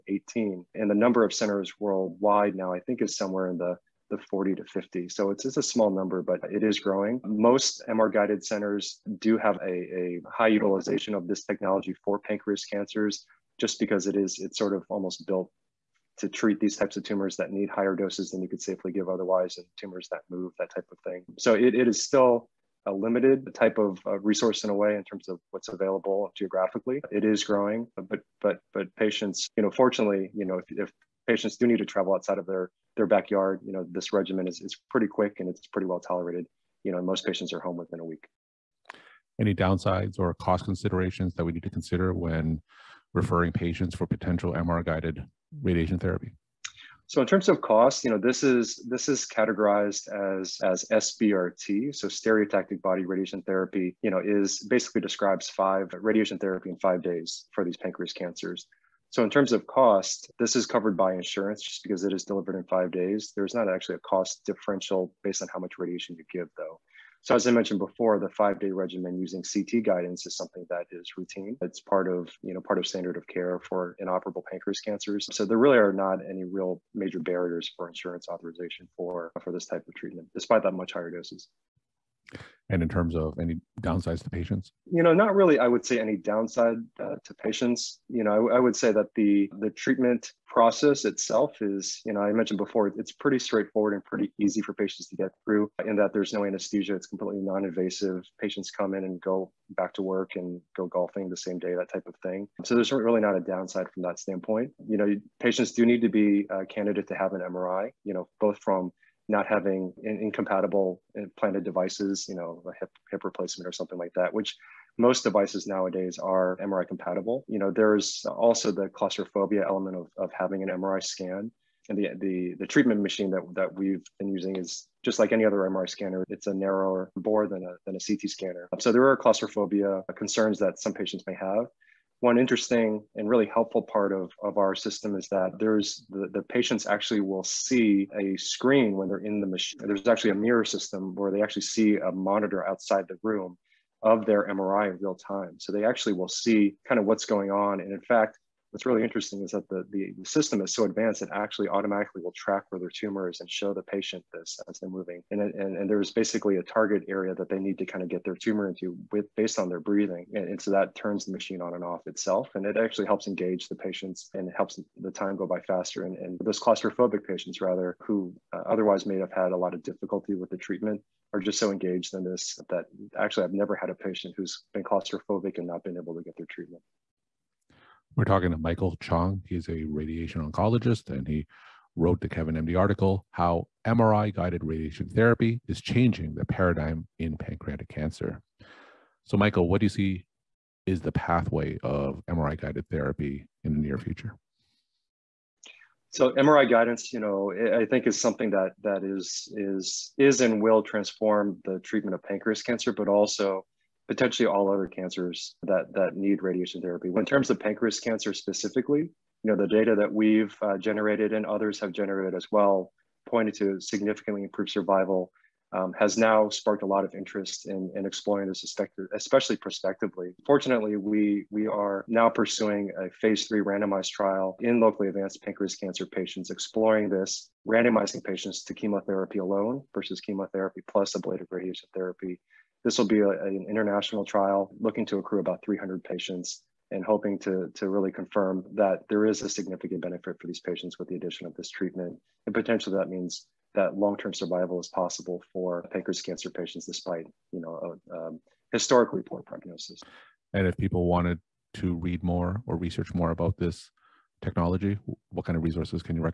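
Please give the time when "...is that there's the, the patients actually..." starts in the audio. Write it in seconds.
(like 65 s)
135 s.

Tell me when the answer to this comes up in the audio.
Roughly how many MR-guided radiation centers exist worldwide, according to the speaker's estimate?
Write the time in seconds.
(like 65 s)
4 s.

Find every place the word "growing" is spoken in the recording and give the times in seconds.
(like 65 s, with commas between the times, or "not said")
6 s, 27 s.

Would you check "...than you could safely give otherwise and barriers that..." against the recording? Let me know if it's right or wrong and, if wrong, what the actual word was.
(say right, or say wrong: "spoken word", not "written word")
wrong: "tumors", not "barriers".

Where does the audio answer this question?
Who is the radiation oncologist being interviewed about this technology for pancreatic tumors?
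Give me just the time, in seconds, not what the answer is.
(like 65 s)
178 s.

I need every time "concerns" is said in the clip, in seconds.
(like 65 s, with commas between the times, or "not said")
130 s.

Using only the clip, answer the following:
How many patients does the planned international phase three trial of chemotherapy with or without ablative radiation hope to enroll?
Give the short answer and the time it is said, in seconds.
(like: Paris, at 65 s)
300, at 235 s.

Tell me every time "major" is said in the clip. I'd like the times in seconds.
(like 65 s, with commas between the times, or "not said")
76 s.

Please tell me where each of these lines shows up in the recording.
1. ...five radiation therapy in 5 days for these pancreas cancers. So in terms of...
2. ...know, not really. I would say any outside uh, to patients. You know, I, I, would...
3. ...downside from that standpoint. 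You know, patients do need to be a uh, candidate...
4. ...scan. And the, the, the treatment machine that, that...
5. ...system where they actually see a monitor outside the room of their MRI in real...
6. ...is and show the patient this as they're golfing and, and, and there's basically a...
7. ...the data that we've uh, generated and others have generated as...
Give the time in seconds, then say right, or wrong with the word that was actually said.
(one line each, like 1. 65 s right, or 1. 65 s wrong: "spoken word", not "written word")
1. 55 s right
2. 85 s wrong: "downside", not "outside"
3. 103 s right
4. 121 s right
5. 140 s right
6. 153 s wrong: "moving", not "golfing"
7. 209 s right.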